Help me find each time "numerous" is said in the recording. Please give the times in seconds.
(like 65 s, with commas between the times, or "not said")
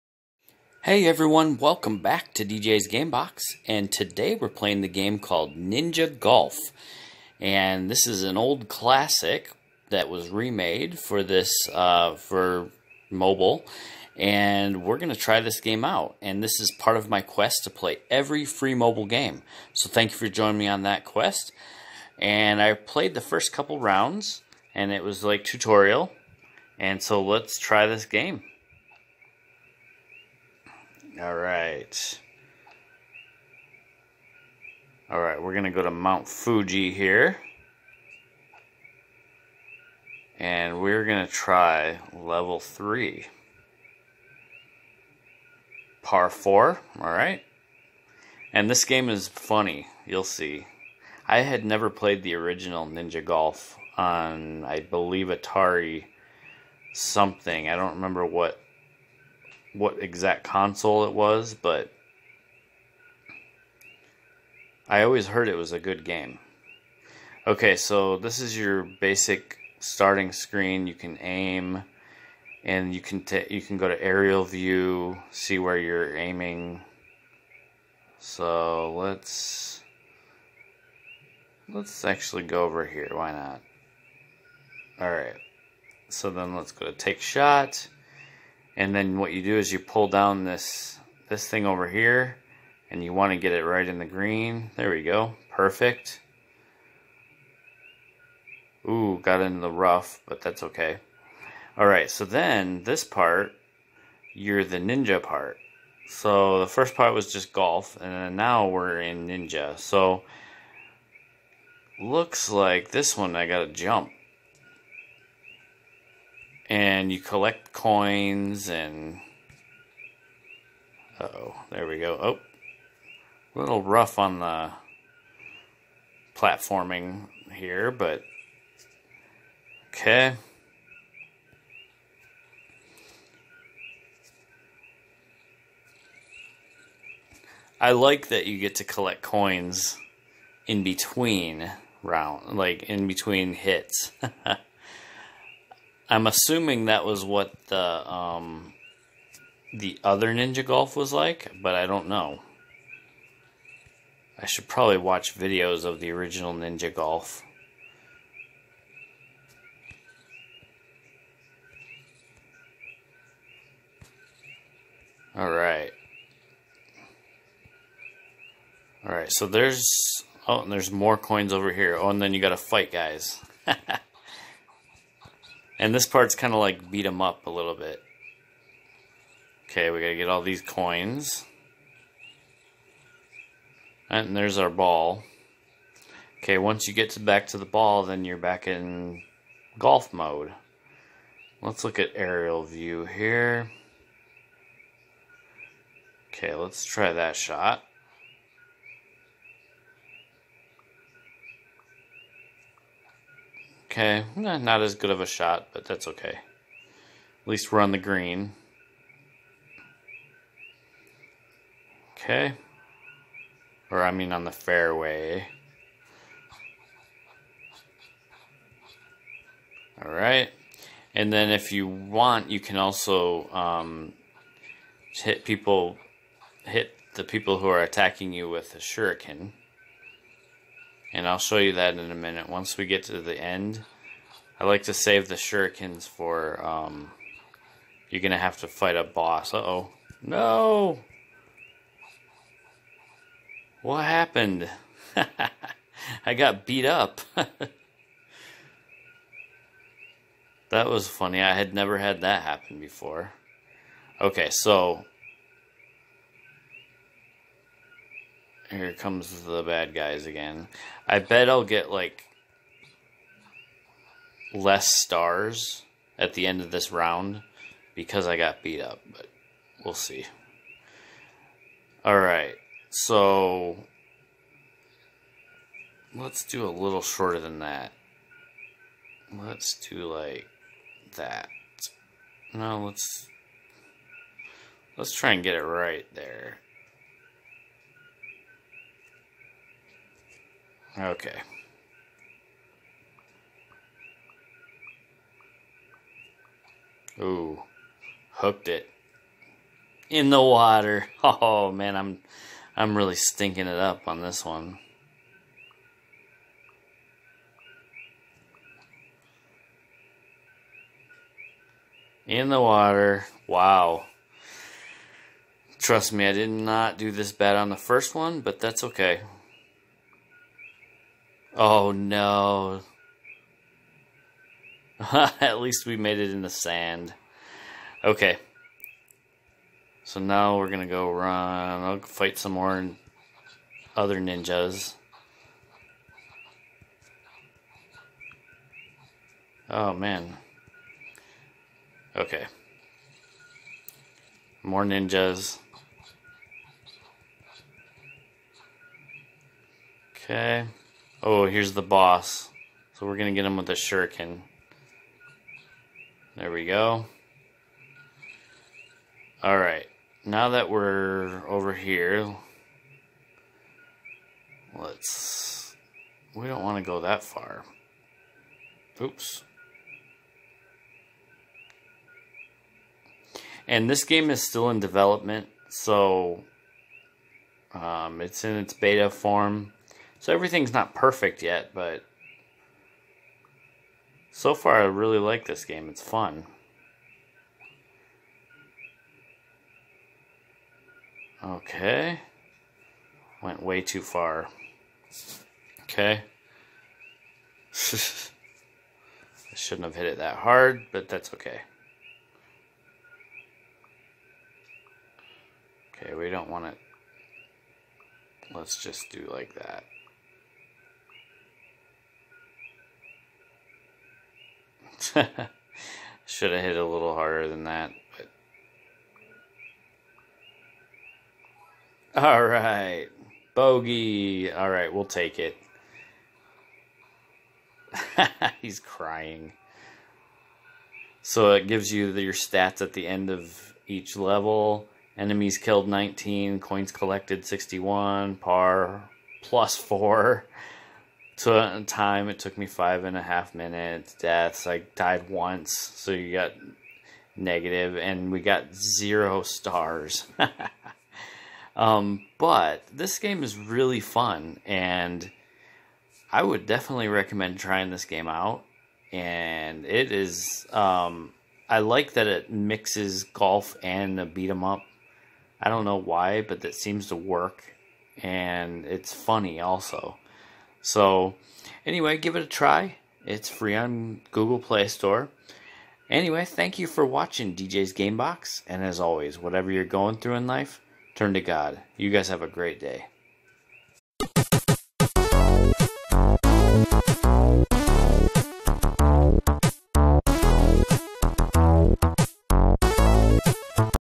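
not said.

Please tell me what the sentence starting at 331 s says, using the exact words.
I'll fight some more other ninjas.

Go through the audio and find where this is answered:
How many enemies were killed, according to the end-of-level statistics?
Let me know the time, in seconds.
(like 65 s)
435 s.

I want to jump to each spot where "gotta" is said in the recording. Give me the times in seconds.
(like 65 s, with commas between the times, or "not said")
113 s, 179 s.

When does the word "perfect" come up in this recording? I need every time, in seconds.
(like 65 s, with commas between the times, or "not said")
95 s, 380 s.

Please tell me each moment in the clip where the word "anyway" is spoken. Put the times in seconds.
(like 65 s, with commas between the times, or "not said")
471 s, 476 s.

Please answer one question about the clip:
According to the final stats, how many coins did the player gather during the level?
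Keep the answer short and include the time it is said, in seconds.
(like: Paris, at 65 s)
61, at 437 s.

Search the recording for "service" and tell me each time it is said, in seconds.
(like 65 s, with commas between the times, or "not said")
not said.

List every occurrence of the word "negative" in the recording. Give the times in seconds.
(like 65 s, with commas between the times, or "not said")
447 s.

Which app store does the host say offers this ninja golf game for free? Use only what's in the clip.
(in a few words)
Google Play Store.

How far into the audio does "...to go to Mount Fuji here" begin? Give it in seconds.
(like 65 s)
35 s.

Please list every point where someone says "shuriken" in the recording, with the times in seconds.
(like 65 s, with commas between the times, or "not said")
228 s, 235 s, 353 s.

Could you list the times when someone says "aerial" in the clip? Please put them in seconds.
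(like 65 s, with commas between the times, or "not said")
74 s, 192 s.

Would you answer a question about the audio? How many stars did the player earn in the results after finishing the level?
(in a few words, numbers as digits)
0.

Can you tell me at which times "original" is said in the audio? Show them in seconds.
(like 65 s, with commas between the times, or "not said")
52 s, 156 s.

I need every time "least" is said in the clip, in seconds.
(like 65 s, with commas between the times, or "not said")
207 s, 325 s.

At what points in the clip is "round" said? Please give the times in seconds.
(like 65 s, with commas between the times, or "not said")
23 s, 142 s, 266 s.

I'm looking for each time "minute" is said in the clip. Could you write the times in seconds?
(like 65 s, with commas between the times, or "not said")
232 s, 443 s.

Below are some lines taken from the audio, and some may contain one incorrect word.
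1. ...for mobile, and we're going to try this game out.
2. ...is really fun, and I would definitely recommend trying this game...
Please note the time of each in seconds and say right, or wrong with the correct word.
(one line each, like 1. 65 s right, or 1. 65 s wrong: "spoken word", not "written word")
1. 12 s right
2. 453 s right.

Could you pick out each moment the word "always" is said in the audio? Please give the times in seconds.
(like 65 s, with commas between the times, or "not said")
65 s, 478 s.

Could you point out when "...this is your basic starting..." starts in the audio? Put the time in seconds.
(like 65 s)
68 s.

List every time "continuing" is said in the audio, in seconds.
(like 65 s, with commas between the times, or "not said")
not said.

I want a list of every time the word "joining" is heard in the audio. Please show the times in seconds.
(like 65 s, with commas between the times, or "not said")
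20 s.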